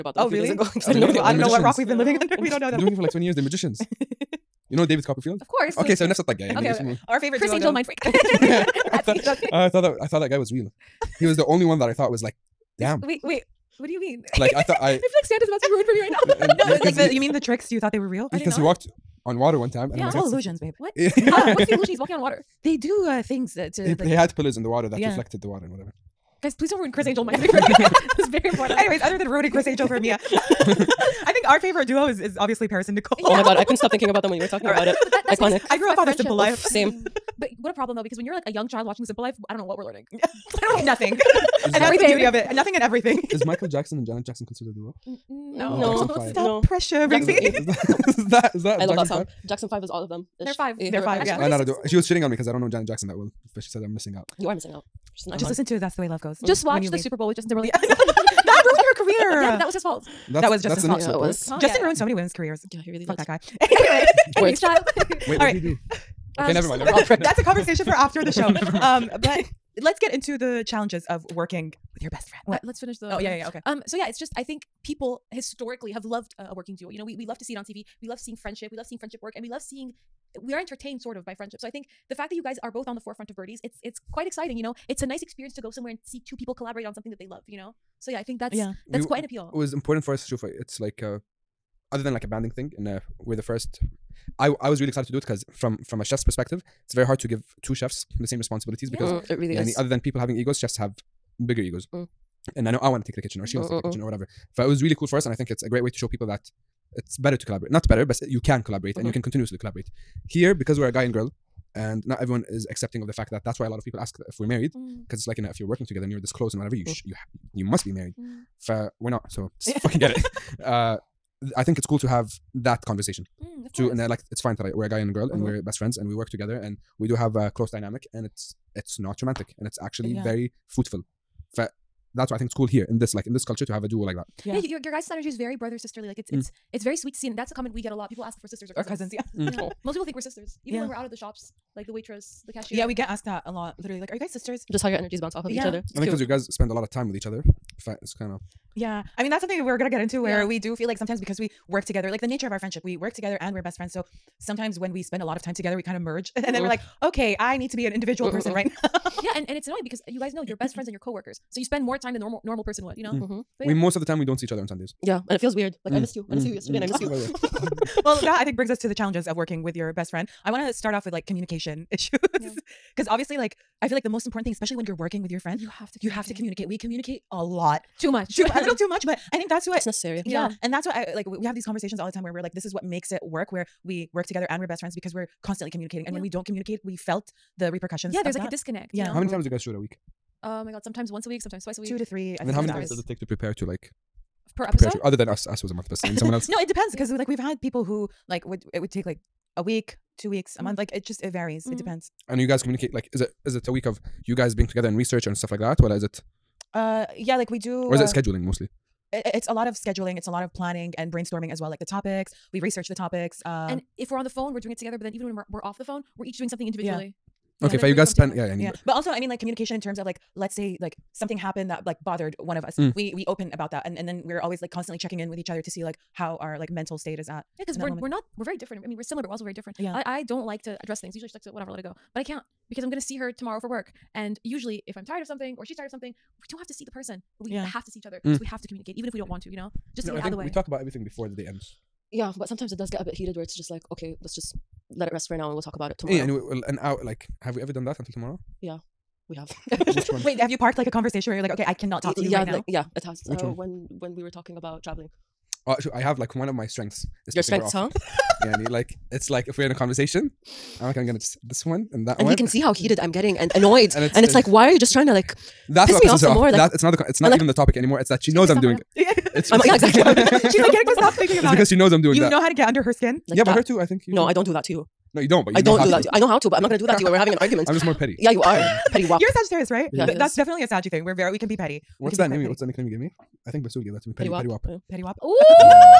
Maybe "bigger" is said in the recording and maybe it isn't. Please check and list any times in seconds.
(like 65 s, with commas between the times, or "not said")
101 s.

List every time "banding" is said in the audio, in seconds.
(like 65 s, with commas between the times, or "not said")
92 s.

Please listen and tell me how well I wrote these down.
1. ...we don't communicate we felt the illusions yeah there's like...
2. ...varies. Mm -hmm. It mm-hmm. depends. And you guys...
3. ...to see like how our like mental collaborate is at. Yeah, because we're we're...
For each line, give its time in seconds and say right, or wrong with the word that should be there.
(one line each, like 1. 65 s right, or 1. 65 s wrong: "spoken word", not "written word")
1. 186 s wrong: "repercussions", not "illusions"
2. 201 s right
3. 225 s wrong: "state", not "collaborate".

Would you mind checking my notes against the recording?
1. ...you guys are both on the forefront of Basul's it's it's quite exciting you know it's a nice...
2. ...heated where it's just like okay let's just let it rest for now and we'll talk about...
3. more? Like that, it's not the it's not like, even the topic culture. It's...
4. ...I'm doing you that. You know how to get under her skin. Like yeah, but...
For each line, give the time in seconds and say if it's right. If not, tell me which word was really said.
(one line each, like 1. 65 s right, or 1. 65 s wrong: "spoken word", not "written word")
1. 82 s wrong: "Birdy", not "Basul"
2. 243 s right
3. 266 s wrong: "anymore", not "culture"
4. 271 s right.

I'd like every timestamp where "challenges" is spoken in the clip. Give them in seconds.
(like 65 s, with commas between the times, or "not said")
70 s, 168 s.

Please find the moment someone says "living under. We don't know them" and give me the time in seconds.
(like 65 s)
2 s.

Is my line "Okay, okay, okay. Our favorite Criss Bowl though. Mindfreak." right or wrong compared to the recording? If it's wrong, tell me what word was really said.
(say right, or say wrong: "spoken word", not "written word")
wrong: "Angel", not "Bowl".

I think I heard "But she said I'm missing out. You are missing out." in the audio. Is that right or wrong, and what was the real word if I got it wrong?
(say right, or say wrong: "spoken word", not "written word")
right.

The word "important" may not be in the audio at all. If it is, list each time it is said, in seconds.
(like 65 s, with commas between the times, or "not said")
28 s, 89 s, 174 s.